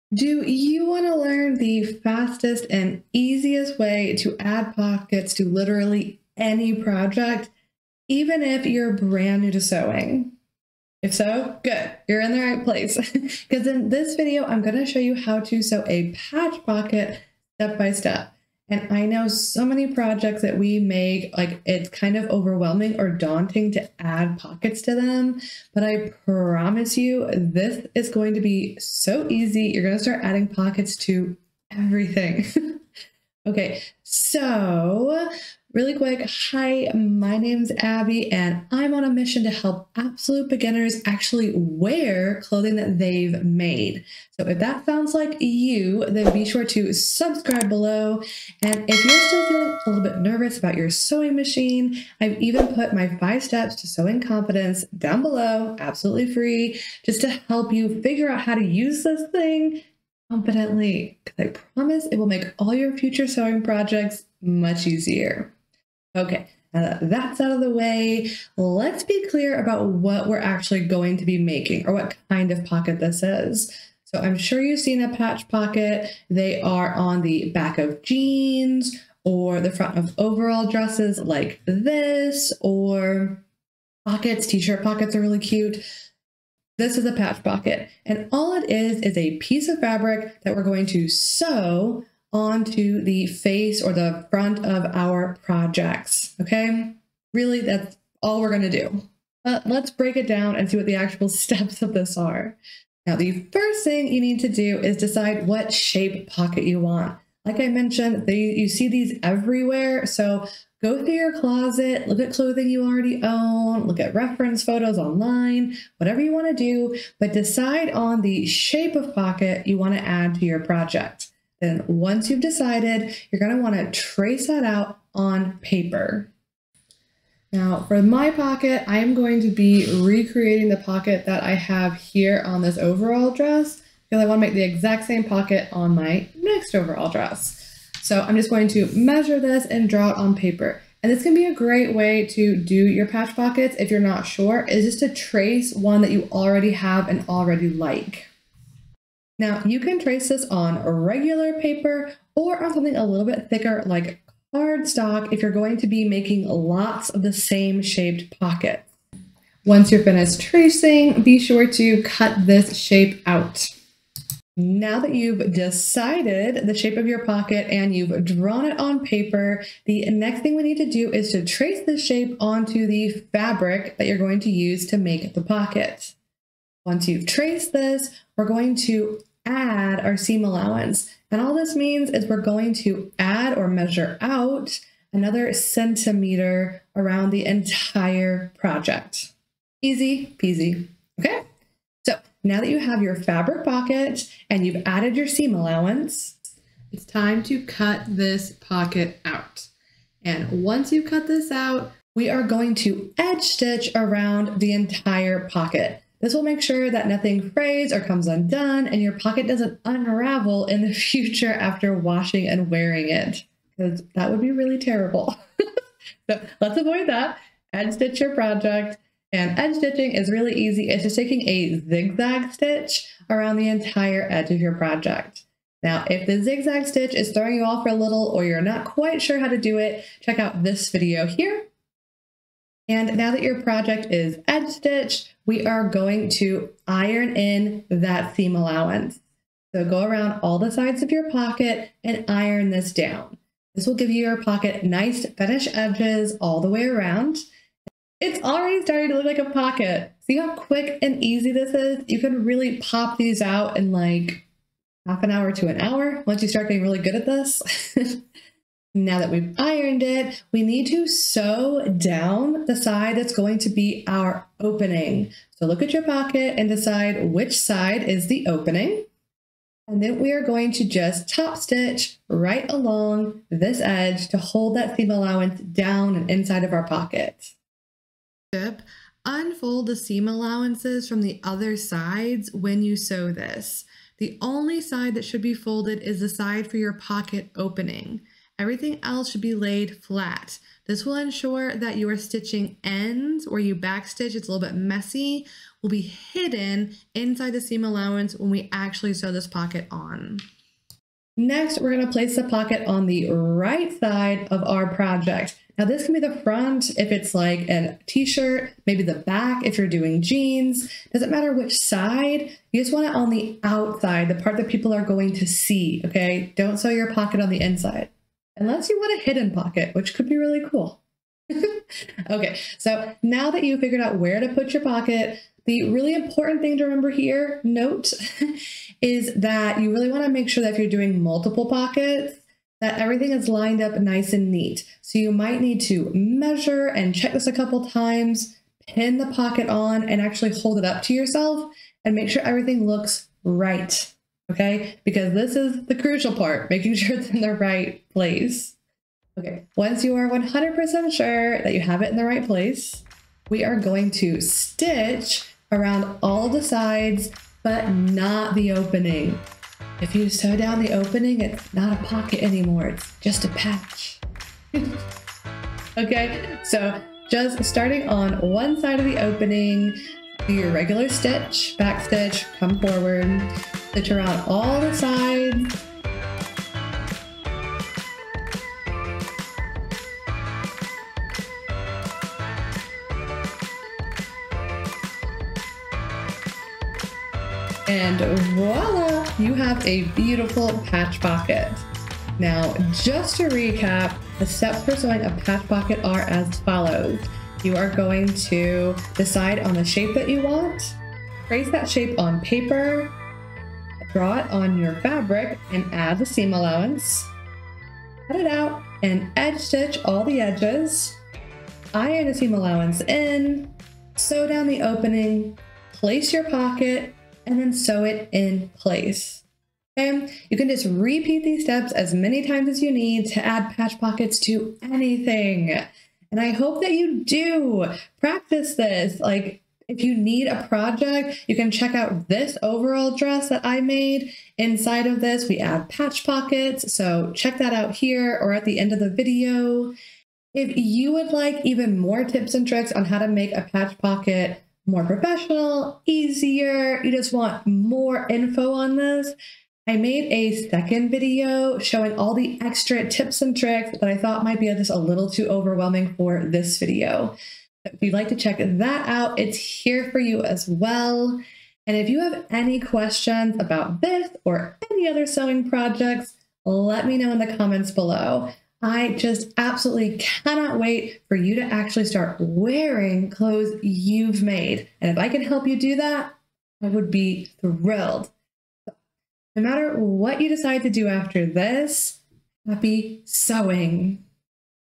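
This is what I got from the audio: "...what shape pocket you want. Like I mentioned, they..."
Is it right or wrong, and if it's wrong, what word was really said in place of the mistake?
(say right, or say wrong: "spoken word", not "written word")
right.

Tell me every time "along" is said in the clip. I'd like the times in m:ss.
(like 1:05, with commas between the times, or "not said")
4:32.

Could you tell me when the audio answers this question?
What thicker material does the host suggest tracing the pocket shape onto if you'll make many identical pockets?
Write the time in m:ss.
2:34.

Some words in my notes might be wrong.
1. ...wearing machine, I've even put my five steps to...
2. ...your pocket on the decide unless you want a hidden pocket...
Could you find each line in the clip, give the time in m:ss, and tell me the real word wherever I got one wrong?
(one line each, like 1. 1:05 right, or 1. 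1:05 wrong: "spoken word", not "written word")
1. 0:50 wrong: "sewing", not "wearing"
2. 5:16 wrong: "inside", not "decide".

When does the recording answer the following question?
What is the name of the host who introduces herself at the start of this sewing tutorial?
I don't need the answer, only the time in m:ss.
0:37.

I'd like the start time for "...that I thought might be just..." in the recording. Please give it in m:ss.
7:33.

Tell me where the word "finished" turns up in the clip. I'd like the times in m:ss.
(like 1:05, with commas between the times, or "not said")
2:40, 4:05.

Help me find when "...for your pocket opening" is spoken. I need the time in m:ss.
4:46.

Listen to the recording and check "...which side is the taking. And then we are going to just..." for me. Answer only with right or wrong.
wrong.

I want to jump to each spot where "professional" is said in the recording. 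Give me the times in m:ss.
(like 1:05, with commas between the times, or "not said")
7:25.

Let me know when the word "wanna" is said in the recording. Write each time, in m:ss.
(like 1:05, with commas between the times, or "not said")
2:03, 2:14.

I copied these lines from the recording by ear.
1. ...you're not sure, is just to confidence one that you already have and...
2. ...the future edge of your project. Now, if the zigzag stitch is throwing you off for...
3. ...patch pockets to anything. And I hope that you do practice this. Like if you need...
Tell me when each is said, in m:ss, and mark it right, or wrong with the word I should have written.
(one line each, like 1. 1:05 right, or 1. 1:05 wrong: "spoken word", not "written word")
1. 2:23 wrong: "trace", not "confidence"
2. 3:43 wrong: "entire", not "future"
3. 7:03 right.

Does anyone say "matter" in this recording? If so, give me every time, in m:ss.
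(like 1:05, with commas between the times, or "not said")
5:11, 7:59.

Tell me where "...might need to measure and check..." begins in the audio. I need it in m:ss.
5:35.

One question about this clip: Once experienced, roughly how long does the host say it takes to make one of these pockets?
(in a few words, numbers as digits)
Half an hour to an hour.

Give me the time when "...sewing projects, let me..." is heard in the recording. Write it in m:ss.
7:45.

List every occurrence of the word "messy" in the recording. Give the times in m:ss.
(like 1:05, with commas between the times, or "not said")
4:54.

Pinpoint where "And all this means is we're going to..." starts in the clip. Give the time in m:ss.
3:01.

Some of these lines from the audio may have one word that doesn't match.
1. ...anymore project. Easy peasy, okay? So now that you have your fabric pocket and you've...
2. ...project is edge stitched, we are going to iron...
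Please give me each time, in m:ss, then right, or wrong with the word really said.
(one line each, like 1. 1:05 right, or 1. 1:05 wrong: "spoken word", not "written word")
1. 3:07 wrong: "entire", not "anymore"
2. 3:53 right.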